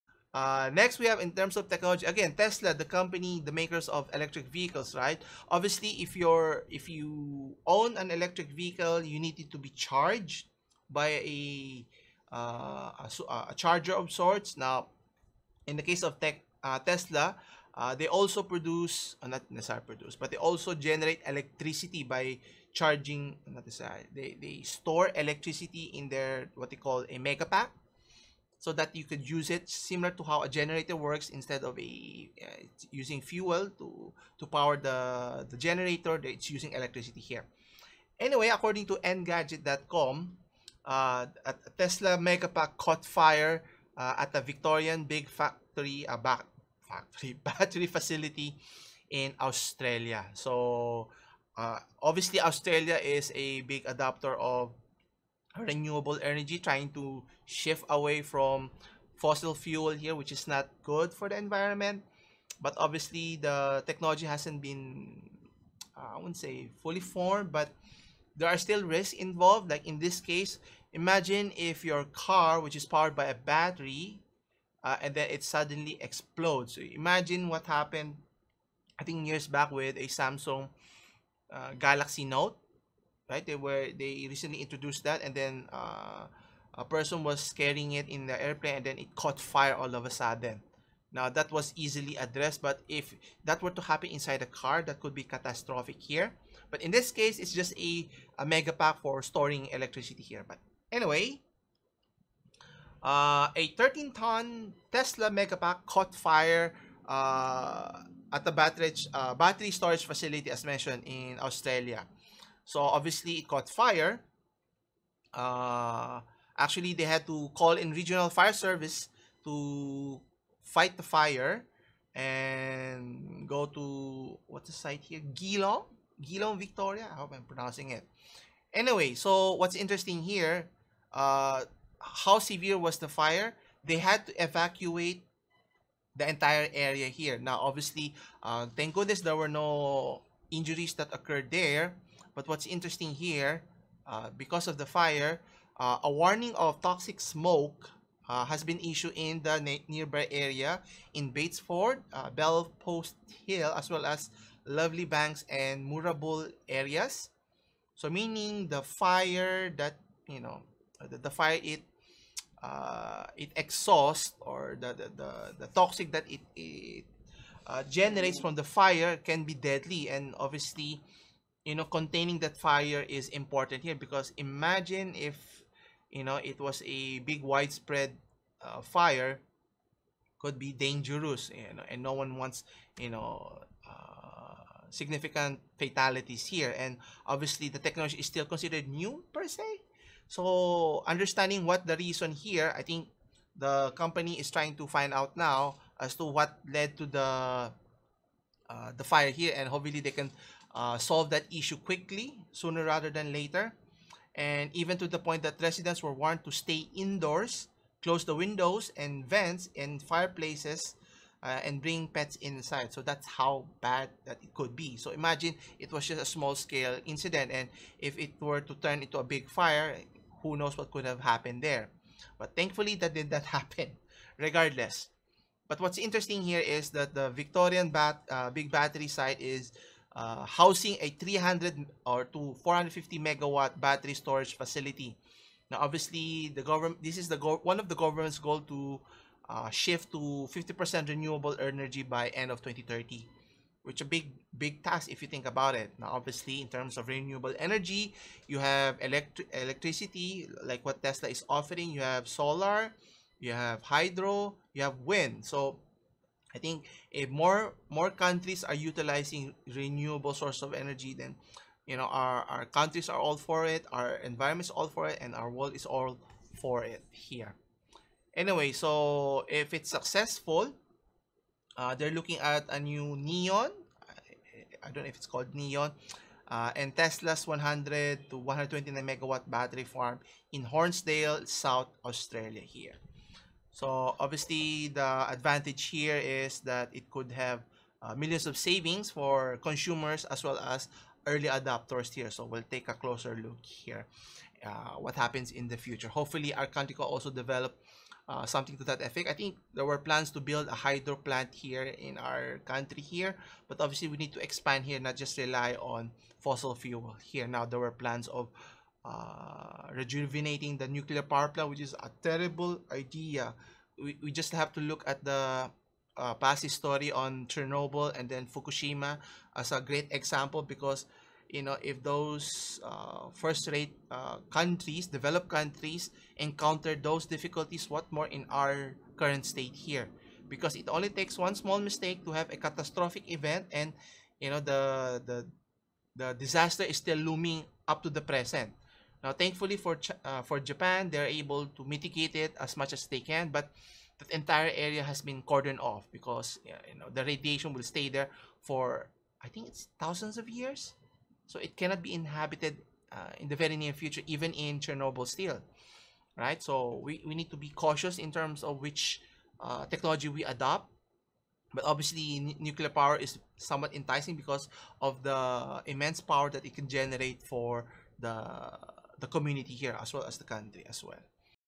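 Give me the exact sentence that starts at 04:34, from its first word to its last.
I, I don't know if it's called neon.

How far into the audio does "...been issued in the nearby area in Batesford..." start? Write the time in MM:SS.
02:28.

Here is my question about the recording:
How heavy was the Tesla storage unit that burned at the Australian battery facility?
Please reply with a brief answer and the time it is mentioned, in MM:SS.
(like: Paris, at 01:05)
13 tons, at 01:43.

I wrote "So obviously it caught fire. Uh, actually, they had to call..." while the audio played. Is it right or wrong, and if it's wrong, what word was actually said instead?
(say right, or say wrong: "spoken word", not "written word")
right.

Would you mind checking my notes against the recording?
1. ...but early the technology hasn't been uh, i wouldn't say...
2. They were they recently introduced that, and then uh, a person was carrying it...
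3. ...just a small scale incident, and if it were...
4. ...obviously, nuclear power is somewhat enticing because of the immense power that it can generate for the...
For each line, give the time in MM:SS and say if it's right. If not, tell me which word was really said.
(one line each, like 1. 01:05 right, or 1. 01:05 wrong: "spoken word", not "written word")
1. 01:02 wrong: "obviously", not "early"
2. 01:23 right
3. 03:36 right
4. 06:01 right.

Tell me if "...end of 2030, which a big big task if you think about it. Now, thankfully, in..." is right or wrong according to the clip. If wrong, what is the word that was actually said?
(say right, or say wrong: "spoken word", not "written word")
wrong: "obviously", not "thankfully".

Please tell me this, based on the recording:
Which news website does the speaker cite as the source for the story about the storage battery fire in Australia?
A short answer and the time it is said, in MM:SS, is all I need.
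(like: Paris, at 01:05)
engadget.com, at 00:39.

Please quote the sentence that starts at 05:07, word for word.
Now there were plans of uh, rejuvenating the nuclear power plant, which is a terrible idea.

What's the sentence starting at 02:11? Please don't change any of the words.
Uh, how severe was the fire?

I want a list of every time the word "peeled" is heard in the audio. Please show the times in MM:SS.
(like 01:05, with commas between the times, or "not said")
not said.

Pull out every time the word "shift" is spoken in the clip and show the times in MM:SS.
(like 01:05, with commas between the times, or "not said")
00:57, 03:59.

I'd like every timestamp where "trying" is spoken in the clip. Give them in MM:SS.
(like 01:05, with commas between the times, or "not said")
00:56, 03:14.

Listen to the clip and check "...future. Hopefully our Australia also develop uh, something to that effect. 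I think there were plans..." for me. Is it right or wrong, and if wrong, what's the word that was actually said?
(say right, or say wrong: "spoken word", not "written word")
wrong: "Arcantica", not "Australia".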